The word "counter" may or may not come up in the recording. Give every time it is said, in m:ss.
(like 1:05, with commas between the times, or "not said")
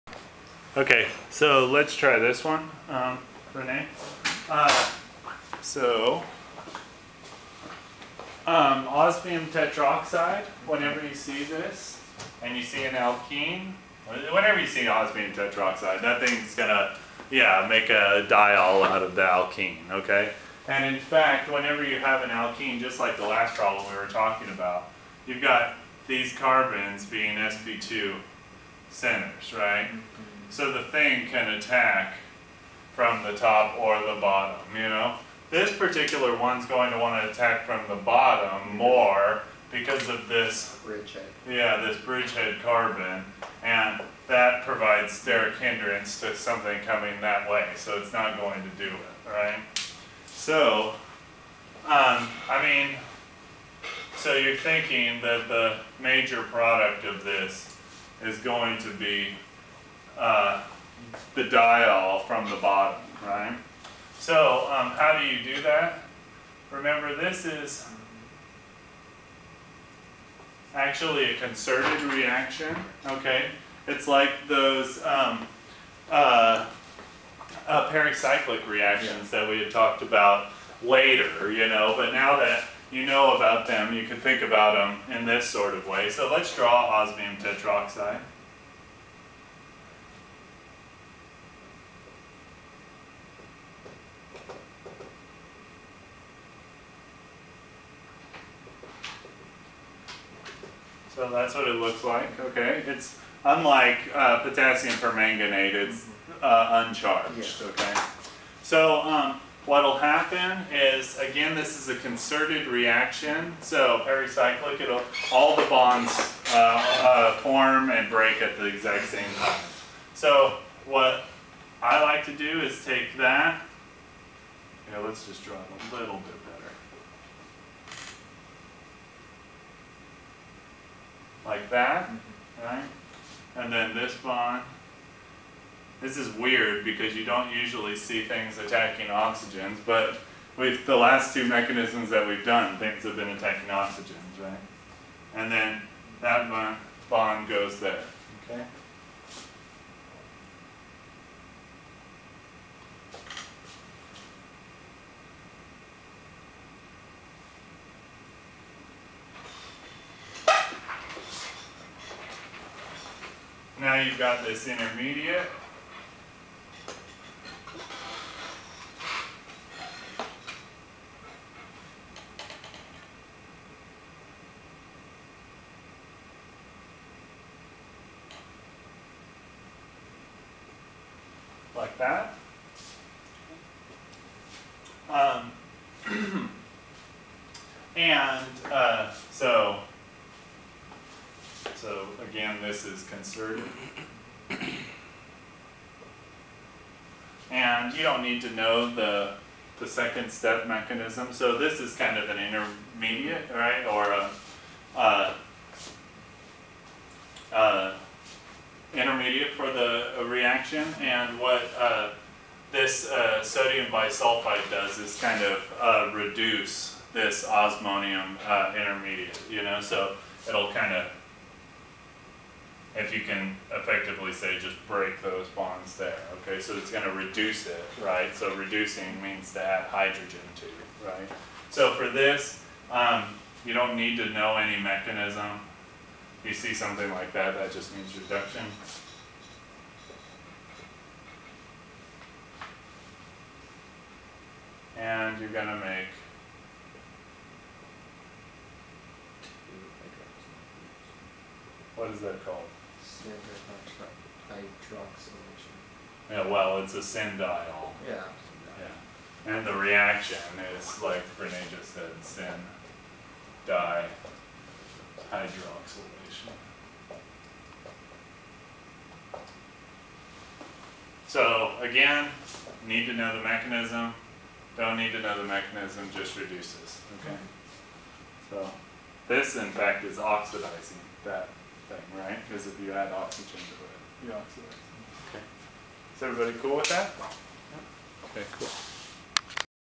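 not said.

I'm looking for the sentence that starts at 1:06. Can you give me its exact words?
Remember, this is actually a concerted reaction, okay?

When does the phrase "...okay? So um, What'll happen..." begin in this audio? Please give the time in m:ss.
1:47.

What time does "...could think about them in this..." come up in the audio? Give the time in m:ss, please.
1:24.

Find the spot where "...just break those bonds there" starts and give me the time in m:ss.
3:44.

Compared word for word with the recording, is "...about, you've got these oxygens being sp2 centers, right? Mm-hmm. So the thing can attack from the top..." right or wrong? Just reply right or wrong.
wrong.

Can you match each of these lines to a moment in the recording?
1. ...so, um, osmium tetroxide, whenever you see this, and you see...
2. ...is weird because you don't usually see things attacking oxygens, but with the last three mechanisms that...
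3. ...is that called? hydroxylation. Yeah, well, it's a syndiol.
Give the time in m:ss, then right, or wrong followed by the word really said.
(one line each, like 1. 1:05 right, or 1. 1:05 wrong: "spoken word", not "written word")
1. 0:05 right
2. 2:16 wrong: "two", not "three"
3. 4:12 right.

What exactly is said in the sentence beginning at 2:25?
And then that bond, bond goes there, okay?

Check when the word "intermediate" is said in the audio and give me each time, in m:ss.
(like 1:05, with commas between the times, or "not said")
2:44, 3:22, 3:28, 3:38.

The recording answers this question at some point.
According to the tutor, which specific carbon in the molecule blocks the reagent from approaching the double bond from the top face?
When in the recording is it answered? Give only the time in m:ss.
0:42.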